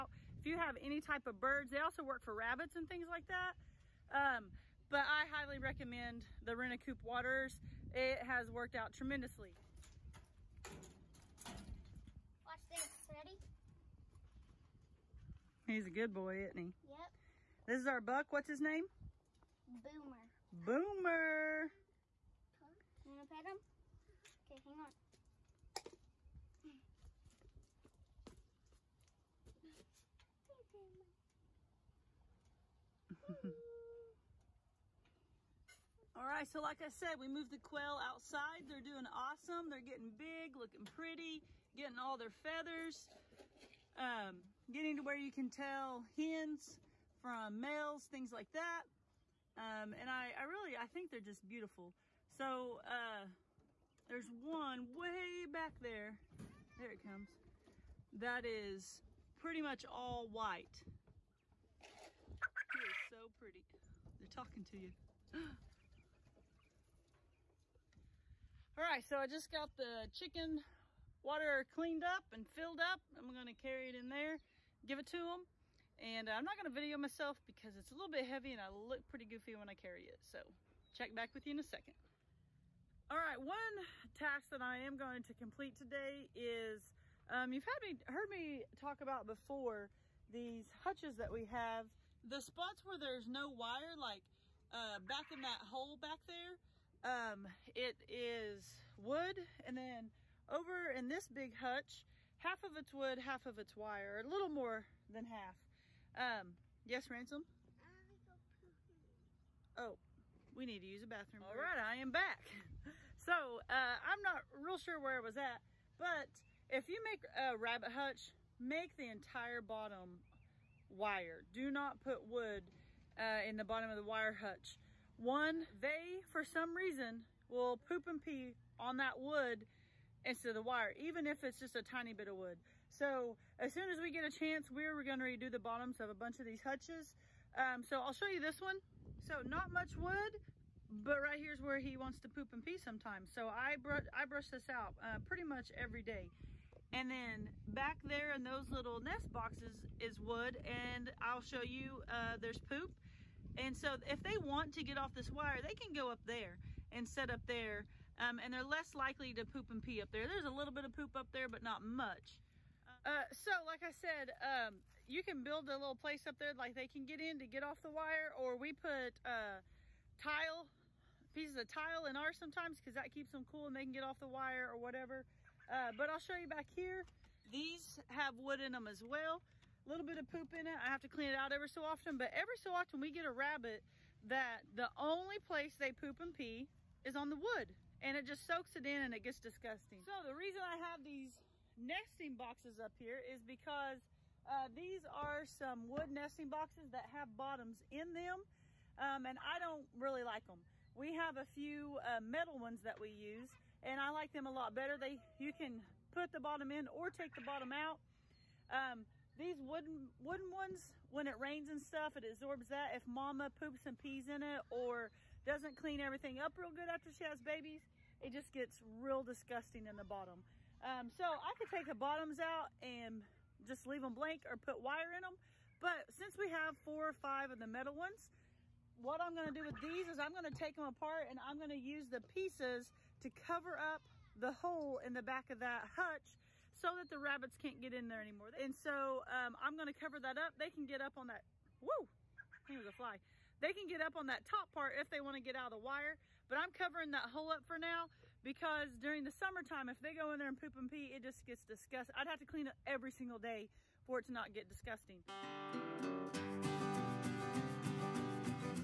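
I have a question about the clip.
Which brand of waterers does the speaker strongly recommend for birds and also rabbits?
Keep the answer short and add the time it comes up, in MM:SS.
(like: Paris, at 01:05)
RentACoop, at 00:06.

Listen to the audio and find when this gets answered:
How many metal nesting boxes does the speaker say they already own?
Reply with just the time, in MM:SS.
03:46.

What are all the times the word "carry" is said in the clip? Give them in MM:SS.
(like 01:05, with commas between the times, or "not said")
01:13, 01:19.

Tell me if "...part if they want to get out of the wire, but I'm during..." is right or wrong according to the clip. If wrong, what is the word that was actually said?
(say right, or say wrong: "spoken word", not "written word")
wrong: "covering", not "during".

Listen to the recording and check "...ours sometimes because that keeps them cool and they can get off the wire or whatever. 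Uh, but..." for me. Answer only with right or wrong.
right.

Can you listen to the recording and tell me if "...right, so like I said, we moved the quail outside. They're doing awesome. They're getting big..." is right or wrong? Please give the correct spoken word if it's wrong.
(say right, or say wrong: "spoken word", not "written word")
right.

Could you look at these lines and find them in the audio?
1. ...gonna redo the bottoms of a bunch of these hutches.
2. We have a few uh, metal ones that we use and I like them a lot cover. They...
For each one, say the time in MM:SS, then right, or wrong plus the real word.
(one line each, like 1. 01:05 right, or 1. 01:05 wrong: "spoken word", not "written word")
1. 02:15 right
2. 03:20 wrong: "better", not "cover".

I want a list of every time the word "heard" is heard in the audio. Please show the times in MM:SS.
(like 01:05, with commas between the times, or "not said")
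01:28.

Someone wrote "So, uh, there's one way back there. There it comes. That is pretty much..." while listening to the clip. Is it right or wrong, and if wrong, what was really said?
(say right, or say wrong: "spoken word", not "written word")
right.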